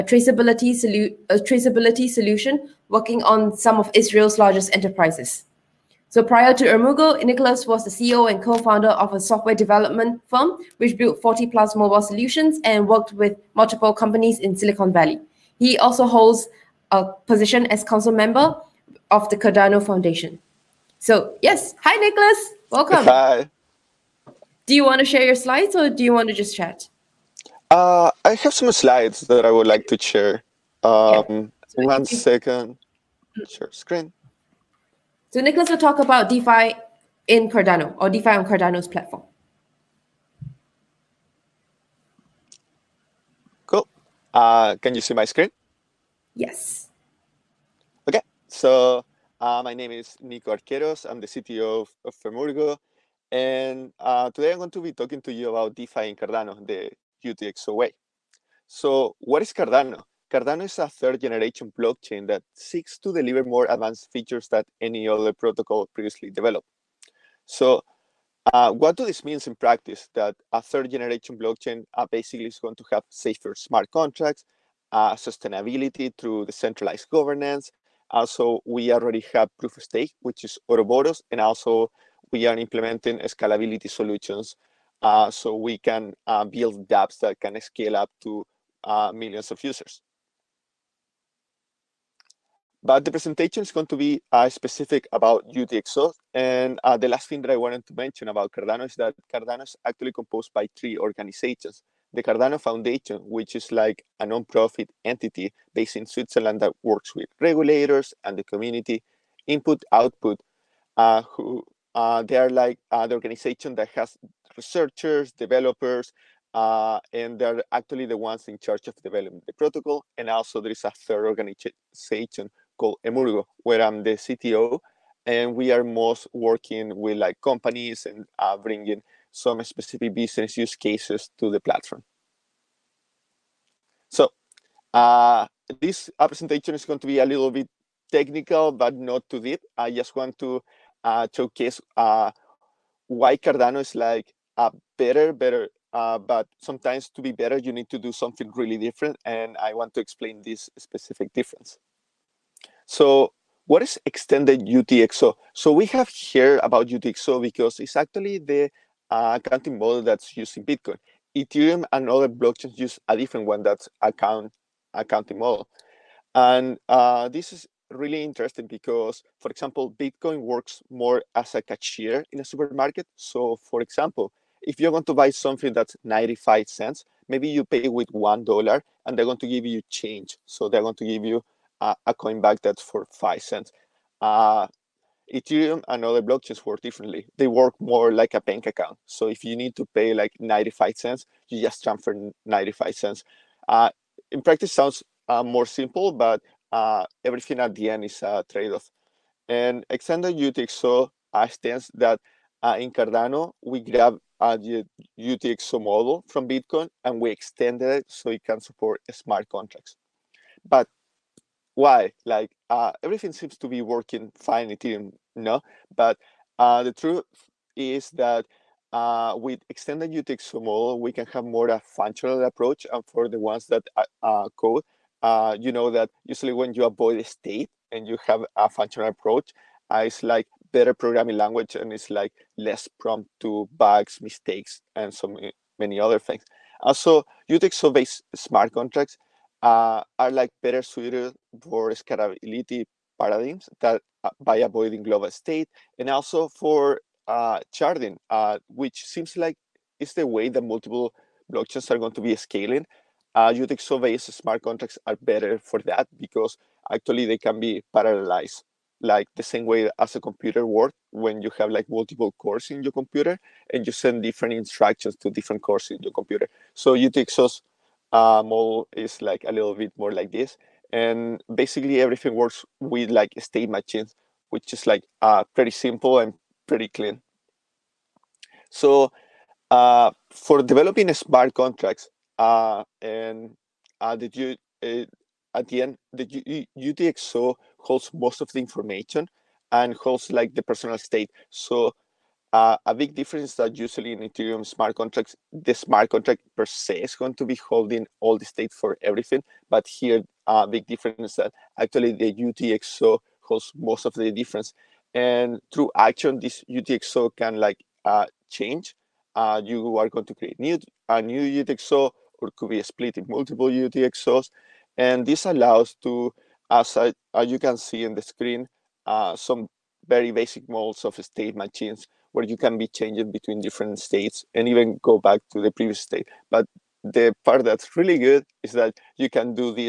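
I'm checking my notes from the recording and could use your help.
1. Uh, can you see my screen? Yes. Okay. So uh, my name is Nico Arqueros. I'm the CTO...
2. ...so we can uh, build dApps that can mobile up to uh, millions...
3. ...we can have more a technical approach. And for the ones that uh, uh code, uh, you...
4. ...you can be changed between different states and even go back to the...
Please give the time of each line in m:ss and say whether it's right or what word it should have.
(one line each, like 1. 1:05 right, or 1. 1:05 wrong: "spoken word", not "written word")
1. 0:44 right
2. 1:25 wrong: "scale", not "mobile"
3. 3:41 wrong: "functional", not "technical"
4. 5:22 right.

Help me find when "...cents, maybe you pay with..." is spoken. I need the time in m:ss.
2:56.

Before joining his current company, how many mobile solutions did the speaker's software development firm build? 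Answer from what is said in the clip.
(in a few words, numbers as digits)
40+.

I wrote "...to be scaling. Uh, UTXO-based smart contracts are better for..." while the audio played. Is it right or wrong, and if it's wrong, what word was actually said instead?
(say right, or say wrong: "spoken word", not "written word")
right.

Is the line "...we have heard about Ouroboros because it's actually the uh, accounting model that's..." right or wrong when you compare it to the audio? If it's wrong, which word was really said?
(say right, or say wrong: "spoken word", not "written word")
wrong: "UTXO", not "Ouroboros".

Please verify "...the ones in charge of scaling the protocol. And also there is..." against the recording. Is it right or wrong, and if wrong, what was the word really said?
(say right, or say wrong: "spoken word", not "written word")
wrong: "developing", not "scaling".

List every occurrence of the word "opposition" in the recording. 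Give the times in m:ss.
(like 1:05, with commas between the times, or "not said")
not said.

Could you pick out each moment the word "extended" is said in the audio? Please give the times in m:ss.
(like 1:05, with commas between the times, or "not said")
2:34, 3:19, 3:27, 3:39.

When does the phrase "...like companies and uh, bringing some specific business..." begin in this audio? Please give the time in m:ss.
2:07.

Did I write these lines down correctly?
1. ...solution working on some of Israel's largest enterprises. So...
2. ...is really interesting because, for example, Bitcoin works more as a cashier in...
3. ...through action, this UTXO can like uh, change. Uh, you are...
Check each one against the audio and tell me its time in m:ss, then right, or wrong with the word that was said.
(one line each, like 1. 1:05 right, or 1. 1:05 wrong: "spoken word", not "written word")
1. 0:02 right
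2. 2:47 right
3. 5:05 right.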